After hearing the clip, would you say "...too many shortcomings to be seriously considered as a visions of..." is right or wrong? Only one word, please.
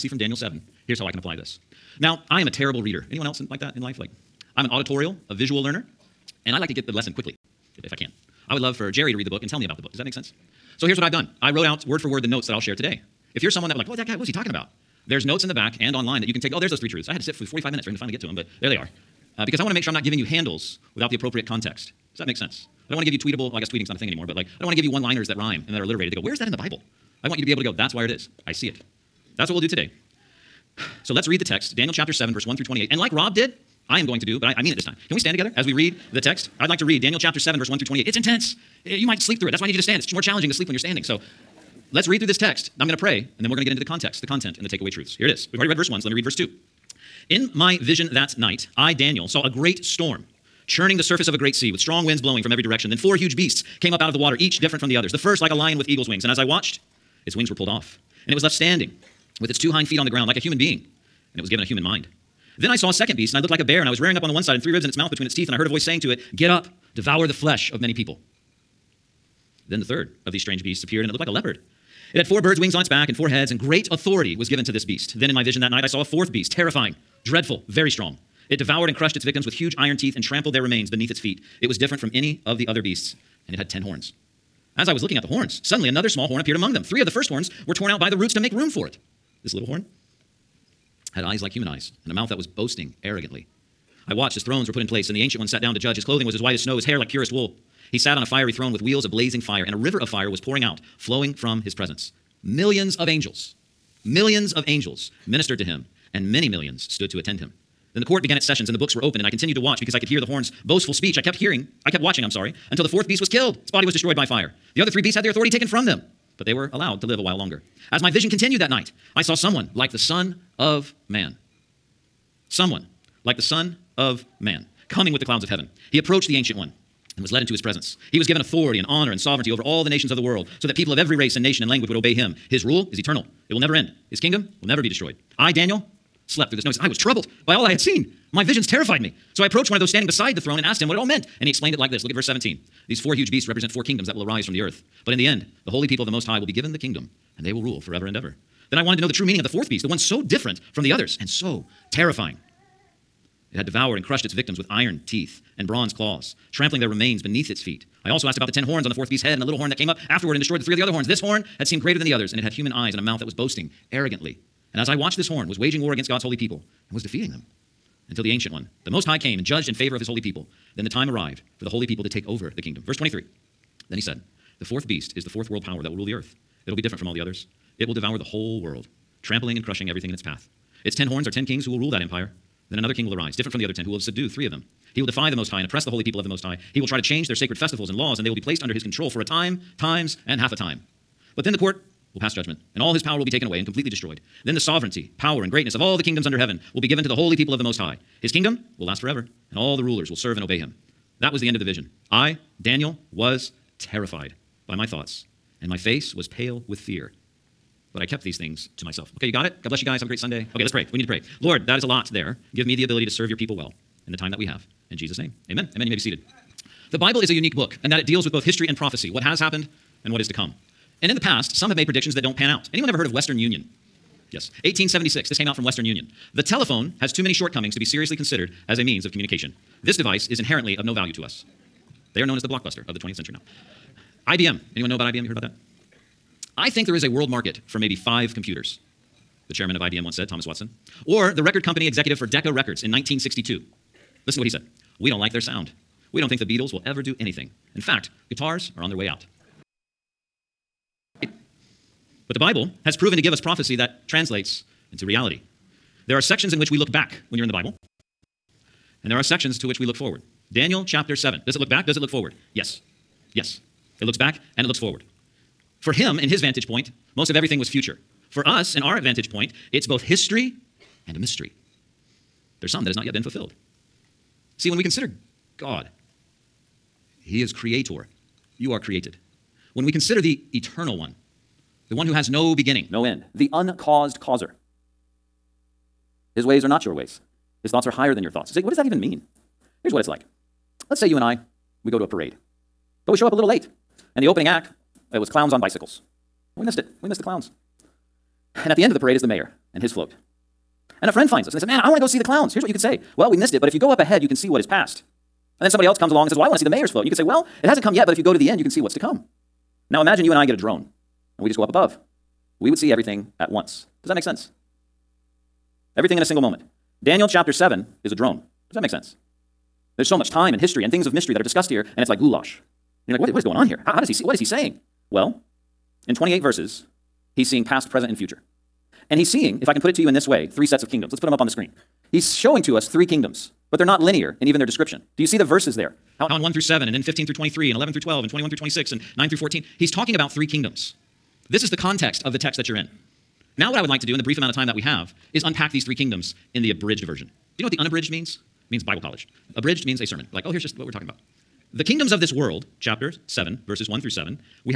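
wrong.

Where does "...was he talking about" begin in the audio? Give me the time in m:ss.
0:14.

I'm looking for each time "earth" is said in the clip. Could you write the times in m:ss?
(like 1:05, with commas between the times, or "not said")
2:24, 2:56.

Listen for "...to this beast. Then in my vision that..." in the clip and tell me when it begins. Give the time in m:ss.
1:14.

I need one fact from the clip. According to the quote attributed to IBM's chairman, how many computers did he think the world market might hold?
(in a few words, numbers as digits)
5.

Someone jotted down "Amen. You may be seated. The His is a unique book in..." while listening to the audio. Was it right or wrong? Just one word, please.
wrong.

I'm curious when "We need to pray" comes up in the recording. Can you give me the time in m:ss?
3:30.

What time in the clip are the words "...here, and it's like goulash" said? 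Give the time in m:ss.
5:21.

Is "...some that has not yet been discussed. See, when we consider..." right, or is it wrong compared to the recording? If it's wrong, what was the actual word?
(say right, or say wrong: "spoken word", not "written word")
wrong: "fulfilled", not "discussed".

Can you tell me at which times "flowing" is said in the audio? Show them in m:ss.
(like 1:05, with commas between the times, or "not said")
1:40.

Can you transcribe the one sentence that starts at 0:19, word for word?
Uh, because I want to make sure I'm not giving you handles without the appropriate context.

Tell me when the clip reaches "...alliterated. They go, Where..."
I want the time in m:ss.
0:25.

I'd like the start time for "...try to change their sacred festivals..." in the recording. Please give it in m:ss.
3:06.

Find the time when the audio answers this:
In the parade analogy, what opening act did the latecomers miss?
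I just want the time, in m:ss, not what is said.
4:55.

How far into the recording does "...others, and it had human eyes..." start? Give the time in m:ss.
2:42.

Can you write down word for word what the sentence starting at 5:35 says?
Do you see the verses there?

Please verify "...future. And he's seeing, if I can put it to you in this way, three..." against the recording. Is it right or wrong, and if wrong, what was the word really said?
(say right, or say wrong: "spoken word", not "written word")
right.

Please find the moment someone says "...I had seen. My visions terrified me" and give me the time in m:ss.
2:17.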